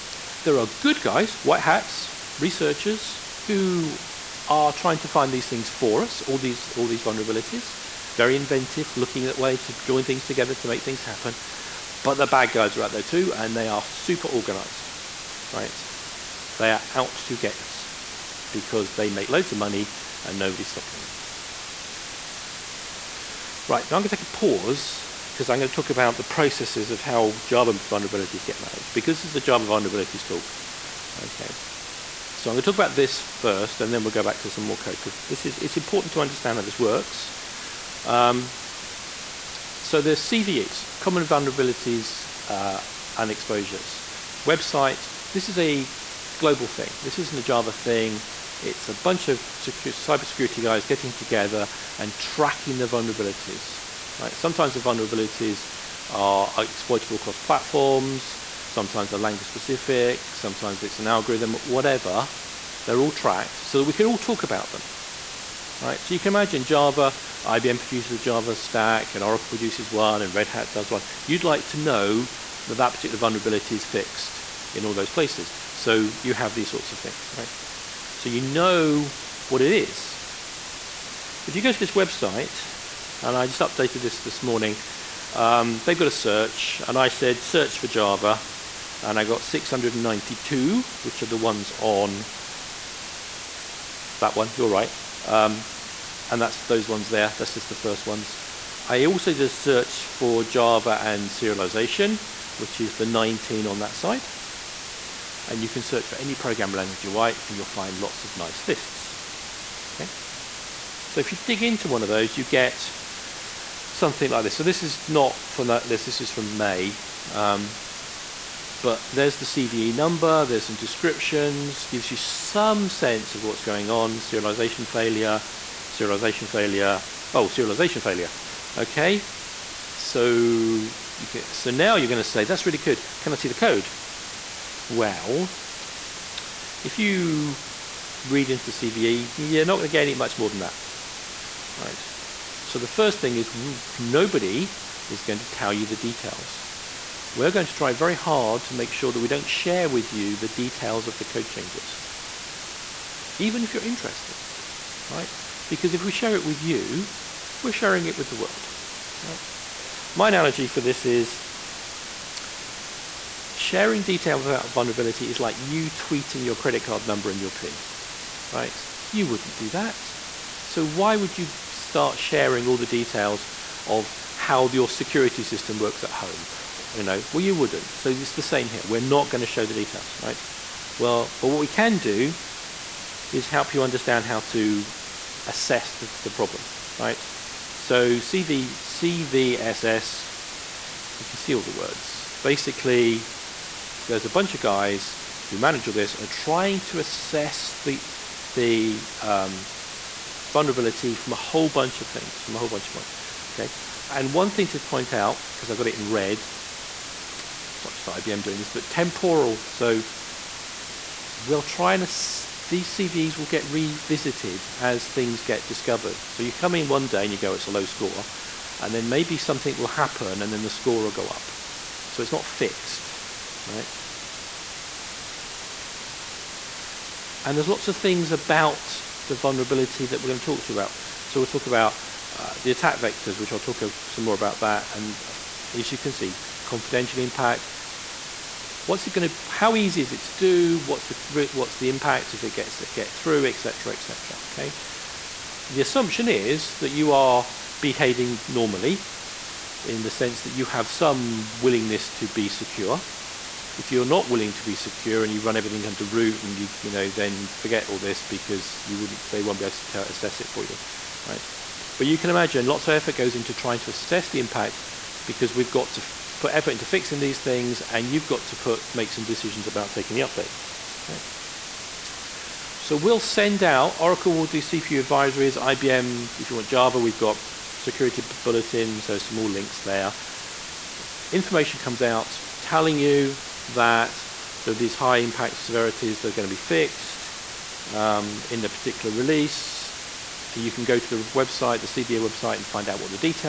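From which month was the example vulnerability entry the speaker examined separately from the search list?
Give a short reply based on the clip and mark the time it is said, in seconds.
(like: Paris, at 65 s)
May, at 116 s.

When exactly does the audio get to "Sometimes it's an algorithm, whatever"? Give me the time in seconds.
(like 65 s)
60 s.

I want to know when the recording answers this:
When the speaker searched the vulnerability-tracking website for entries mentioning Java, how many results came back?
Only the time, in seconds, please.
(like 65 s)
89 s.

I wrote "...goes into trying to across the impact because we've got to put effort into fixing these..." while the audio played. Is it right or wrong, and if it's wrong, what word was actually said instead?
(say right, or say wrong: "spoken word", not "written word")
wrong: "assess", not "across".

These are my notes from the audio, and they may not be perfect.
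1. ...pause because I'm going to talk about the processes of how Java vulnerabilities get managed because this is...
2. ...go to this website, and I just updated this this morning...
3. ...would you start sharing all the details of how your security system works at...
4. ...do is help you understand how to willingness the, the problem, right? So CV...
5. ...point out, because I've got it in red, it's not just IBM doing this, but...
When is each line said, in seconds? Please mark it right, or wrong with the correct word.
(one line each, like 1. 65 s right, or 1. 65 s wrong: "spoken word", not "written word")
1. 24 s right
2. 81 s right
3. 171 s right
4. 181 s wrong: "assess", not "willingness"
5. 204 s right.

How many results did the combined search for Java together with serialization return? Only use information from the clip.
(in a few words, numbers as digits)
19.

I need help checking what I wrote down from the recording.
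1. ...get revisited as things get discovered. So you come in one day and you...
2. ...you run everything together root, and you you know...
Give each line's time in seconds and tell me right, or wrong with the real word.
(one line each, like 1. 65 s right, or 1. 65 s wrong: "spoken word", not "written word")
1. 213 s right
2. 255 s wrong: "under", not "together".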